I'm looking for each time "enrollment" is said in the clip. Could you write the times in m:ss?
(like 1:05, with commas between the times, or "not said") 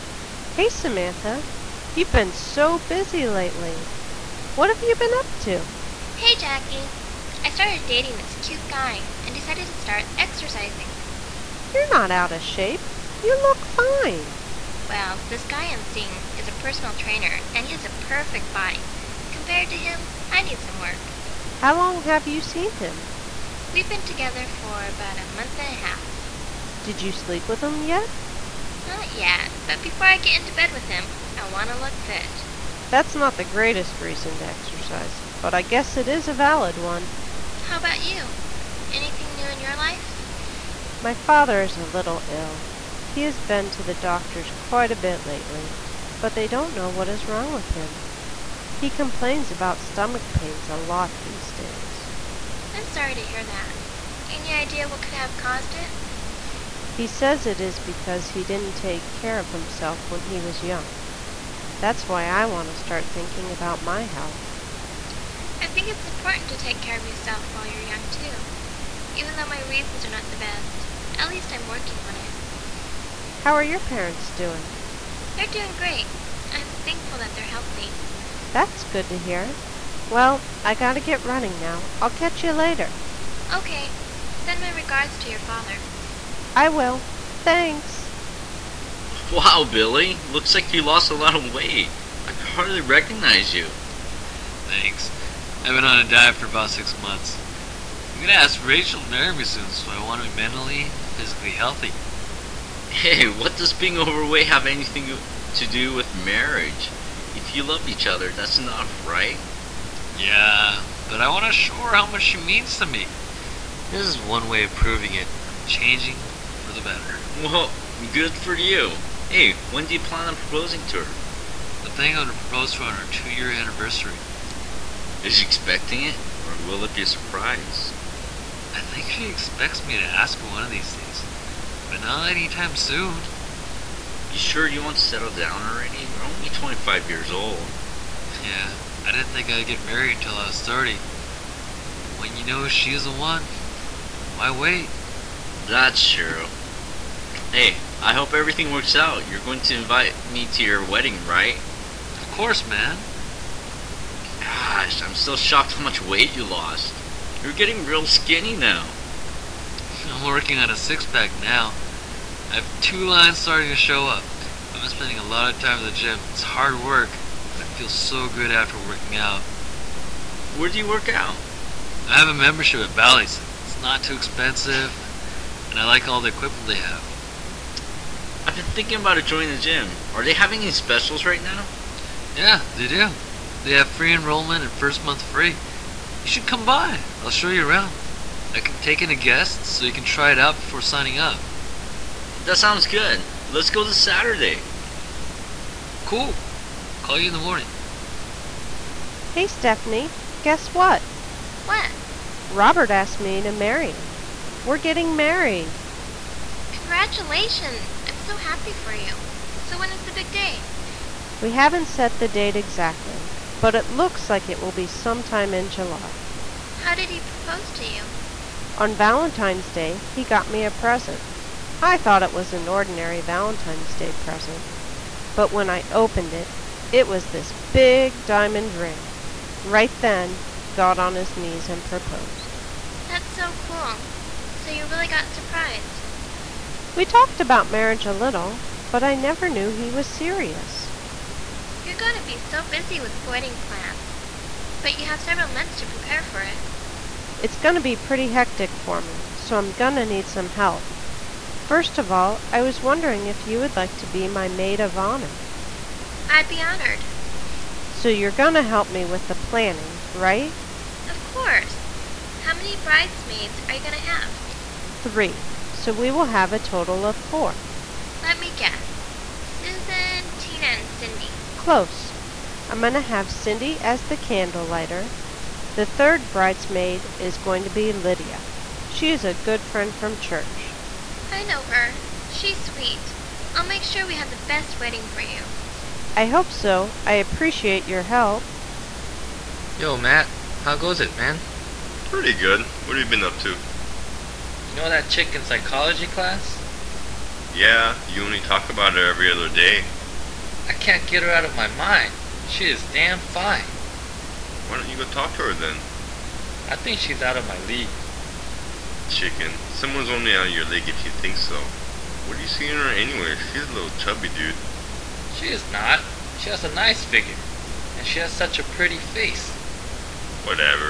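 3:04.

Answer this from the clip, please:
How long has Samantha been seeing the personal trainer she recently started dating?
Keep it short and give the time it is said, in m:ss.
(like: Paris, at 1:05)
a month and a half, at 0:24.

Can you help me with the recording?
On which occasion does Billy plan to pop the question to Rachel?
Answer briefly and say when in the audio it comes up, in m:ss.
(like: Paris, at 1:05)
two-year anniversary, at 2:03.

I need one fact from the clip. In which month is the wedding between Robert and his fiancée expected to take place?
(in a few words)
July.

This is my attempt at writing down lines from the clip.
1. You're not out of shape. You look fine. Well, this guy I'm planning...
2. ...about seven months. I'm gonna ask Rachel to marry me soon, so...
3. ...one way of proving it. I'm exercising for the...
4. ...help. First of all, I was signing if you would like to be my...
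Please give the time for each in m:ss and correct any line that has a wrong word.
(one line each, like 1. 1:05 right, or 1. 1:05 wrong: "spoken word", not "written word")
1. 0:11 wrong: "seeing", not "planning"
2. 1:36 wrong: "six", not "seven"
3. 1:54 wrong: "changing", not "exercising"
4. 4:10 wrong: "wondering", not "signing".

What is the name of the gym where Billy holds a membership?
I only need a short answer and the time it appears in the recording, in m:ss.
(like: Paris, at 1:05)
Bally's, at 2:52.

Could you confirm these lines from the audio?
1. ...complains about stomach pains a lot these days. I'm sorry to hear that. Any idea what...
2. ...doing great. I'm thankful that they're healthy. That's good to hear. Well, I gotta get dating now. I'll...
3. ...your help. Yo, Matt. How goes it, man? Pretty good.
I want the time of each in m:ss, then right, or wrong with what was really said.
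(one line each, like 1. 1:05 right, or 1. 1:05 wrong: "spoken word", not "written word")
1. 0:48 right
2. 1:15 wrong: "running", not "dating"
3. 4:47 right.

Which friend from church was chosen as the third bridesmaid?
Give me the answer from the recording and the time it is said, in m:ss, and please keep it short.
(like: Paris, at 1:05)
Lydia, at 4:37.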